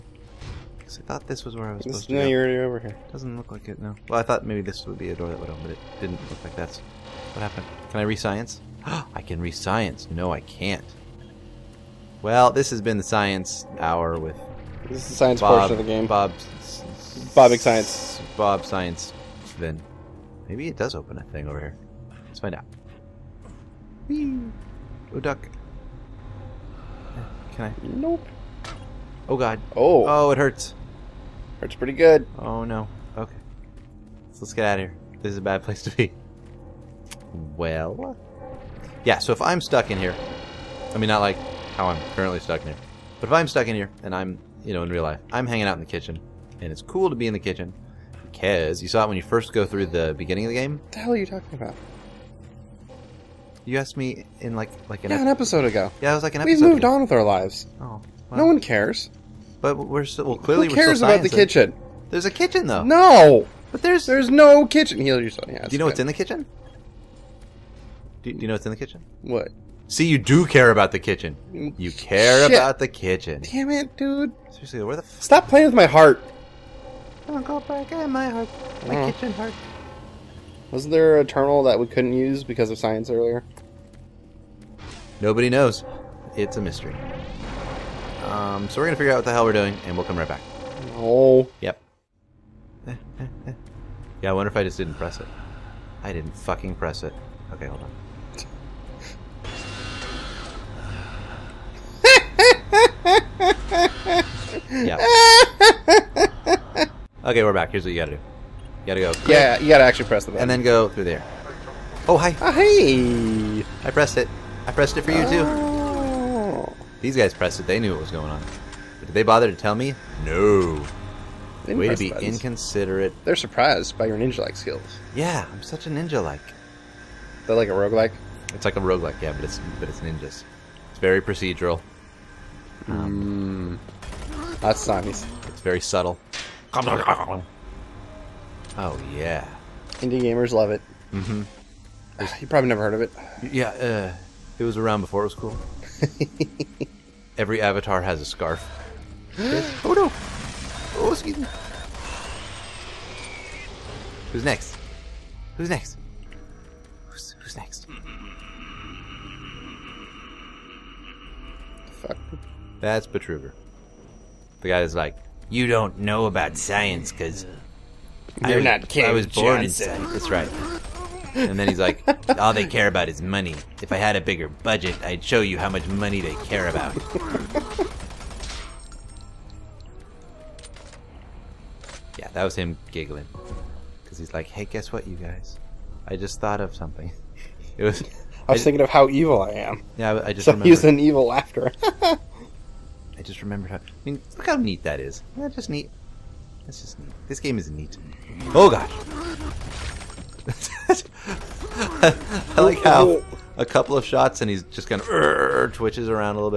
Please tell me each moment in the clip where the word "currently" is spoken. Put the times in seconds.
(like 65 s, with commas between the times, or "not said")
42 s.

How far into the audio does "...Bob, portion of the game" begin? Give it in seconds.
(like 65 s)
15 s.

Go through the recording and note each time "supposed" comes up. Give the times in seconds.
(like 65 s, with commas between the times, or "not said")
2 s.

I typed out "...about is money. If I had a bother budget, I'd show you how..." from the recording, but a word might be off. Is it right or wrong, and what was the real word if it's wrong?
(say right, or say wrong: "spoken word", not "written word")
wrong: "bigger", not "bother".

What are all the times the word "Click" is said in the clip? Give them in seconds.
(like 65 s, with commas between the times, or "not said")
109 s.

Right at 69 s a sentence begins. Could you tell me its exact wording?
See, you do care about the kitchen.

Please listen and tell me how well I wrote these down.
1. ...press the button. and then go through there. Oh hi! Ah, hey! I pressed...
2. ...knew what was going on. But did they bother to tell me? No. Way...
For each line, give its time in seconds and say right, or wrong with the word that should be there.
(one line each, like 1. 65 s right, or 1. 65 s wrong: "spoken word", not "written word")
1. 110 s right
2. 117 s right.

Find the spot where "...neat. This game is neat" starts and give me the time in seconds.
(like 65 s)
196 s.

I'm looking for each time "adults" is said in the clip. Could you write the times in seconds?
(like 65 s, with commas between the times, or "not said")
not said.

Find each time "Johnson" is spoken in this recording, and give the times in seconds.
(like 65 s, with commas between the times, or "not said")
169 s.